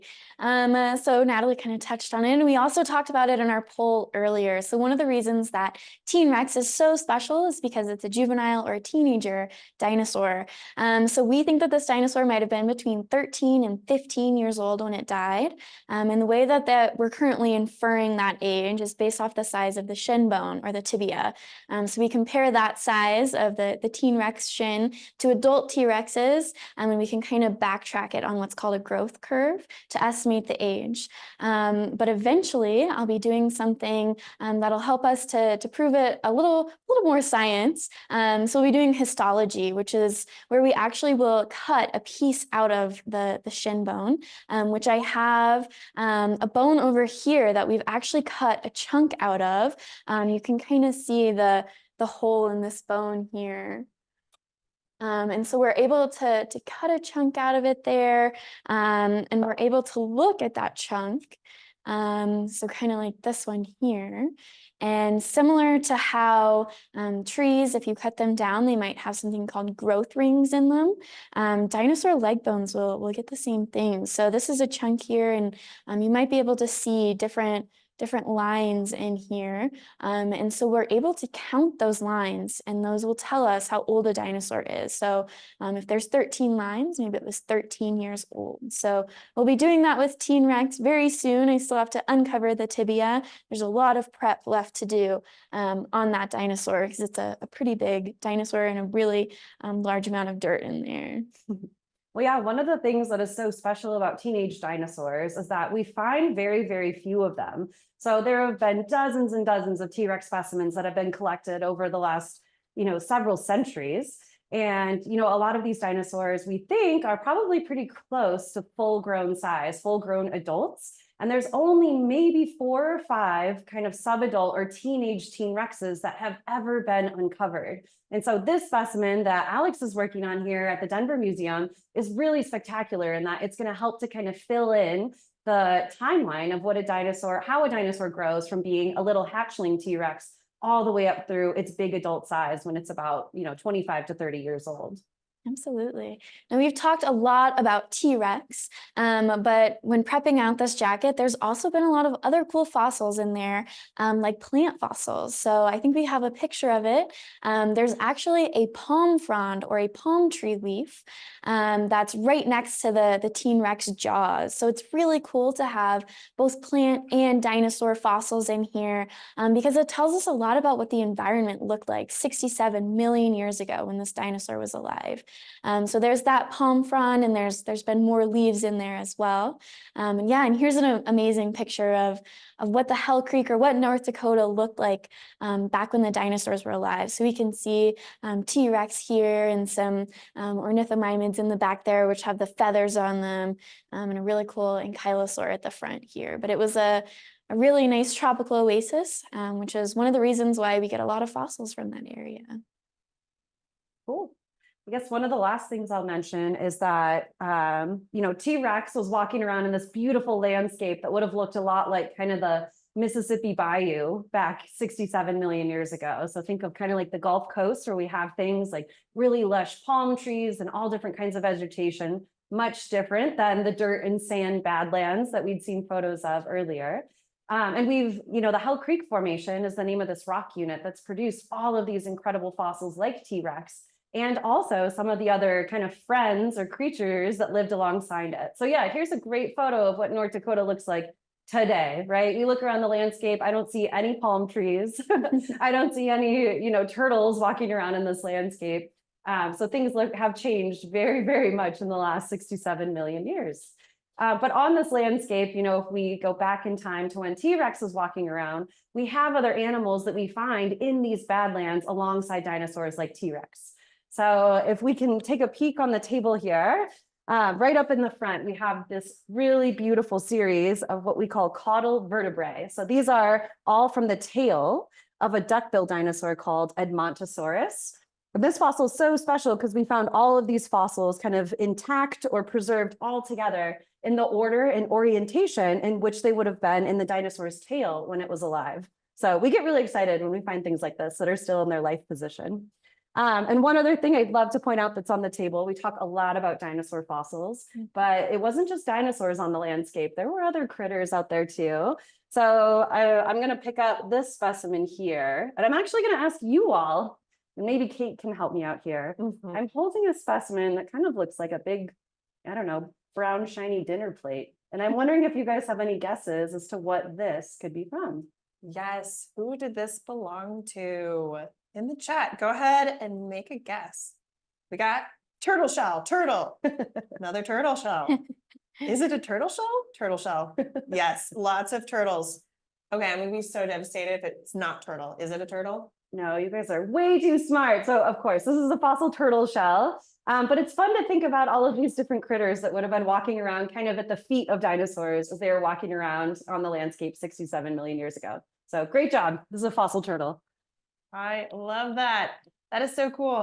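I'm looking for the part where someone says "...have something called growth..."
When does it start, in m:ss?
1:08.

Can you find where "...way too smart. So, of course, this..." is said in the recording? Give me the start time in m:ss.
5:36.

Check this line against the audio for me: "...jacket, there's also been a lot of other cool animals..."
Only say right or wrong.
wrong.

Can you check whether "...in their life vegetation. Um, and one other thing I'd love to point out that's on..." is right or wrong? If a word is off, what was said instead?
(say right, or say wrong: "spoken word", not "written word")
wrong: "position", not "vegetation".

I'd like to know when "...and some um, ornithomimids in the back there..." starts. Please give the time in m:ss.
3:09.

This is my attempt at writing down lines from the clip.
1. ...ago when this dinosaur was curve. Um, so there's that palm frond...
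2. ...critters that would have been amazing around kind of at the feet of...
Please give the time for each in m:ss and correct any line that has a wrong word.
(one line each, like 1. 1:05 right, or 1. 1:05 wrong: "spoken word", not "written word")
1. 2:53 wrong: "alive", not "curve"
2. 5:42 wrong: "walking", not "amazing".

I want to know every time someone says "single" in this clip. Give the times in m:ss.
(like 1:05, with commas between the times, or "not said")
not said.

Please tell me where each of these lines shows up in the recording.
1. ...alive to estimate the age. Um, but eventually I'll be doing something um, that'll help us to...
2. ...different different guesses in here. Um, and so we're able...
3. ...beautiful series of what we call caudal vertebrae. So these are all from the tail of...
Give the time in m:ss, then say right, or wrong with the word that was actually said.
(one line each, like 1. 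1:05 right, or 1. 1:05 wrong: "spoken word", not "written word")
1. 0:29 wrong: "curve", not "alive"
2. 1:17 wrong: "lines", not "guesses"
3. 4:29 right.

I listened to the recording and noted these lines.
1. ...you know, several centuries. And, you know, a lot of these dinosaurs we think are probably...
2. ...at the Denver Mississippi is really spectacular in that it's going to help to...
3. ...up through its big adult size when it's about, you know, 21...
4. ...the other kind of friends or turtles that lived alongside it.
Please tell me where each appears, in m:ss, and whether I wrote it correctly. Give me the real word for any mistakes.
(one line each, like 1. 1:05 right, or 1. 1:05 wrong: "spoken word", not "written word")
1. 1:52 right
2. 2:10 wrong: "Museum", not "Mississippi"
3. 2:21 wrong: "25", not "21"
4. 3:55 wrong: "creatures", not "turtles".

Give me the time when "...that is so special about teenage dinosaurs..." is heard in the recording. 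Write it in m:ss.
1:43.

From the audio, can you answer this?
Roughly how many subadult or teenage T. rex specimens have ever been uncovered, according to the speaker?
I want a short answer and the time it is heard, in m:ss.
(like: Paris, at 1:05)
4 or 5, at 2:02.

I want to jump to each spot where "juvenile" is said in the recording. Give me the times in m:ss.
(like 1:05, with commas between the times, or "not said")
0:08.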